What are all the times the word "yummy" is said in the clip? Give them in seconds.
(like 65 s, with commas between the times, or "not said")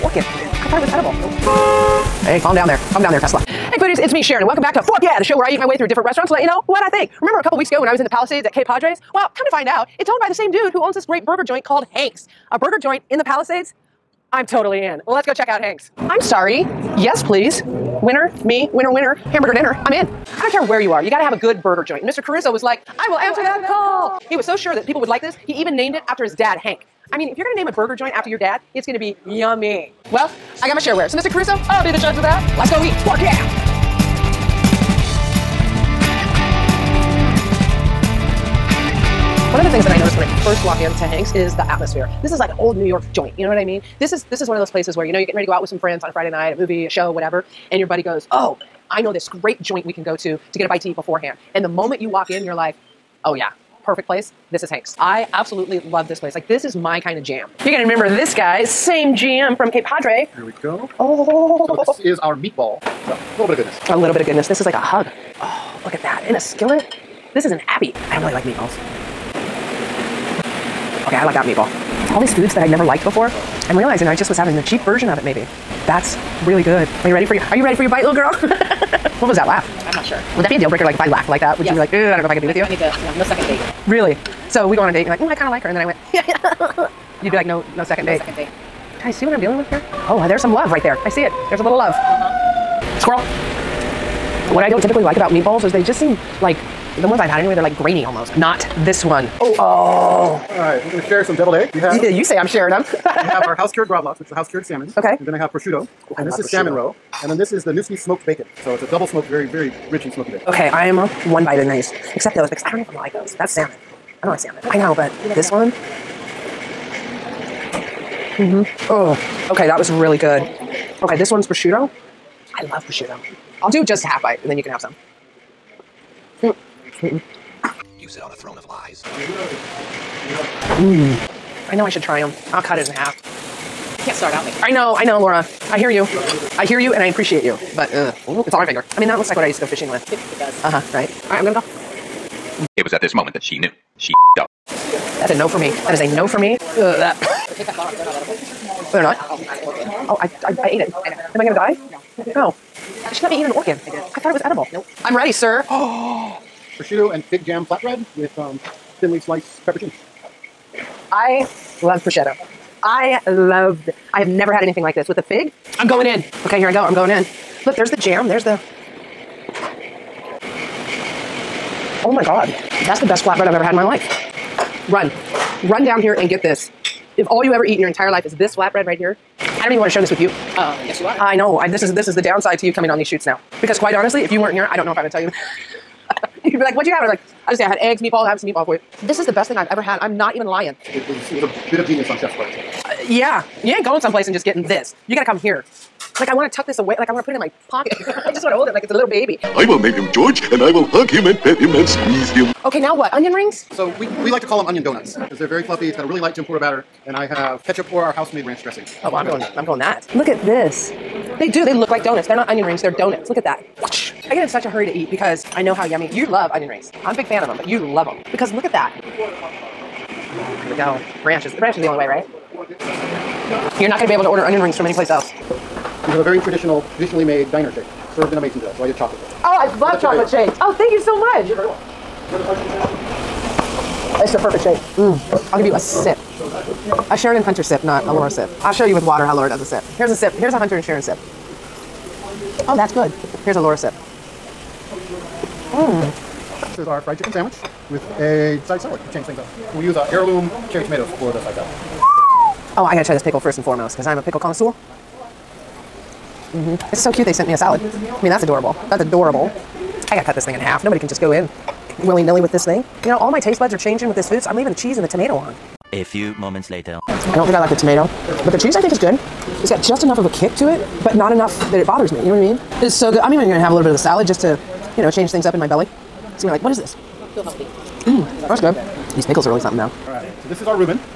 29 s, 215 s.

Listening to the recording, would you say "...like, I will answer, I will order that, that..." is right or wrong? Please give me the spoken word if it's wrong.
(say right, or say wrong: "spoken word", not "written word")
wrong: "answer", not "order".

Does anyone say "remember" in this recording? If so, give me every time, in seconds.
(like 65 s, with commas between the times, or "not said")
7 s, 57 s.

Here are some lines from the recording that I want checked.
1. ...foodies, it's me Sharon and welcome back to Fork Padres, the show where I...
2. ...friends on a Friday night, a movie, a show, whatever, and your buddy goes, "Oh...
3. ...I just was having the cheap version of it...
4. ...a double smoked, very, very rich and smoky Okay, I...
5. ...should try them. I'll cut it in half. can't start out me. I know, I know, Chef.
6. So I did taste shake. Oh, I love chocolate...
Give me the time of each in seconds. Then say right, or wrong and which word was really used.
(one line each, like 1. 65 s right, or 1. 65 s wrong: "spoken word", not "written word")
1. 3 s wrong: "Yeah", not "Padres"
2. 45 s right
3. 74 s right
4. 108 s right
5. 131 s wrong: "Laura", not "Chef"
6. 228 s wrong: "chocolate", not "taste".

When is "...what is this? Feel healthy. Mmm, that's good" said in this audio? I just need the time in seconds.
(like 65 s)
276 s.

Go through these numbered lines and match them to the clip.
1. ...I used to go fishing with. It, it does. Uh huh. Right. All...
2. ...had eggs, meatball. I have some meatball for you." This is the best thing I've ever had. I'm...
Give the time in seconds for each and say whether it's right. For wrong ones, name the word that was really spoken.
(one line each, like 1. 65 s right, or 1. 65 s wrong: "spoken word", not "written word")
1. 139 s right
2. 187 s right.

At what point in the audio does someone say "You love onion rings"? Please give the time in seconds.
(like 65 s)
216 s.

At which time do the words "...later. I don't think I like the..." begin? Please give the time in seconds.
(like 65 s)
266 s.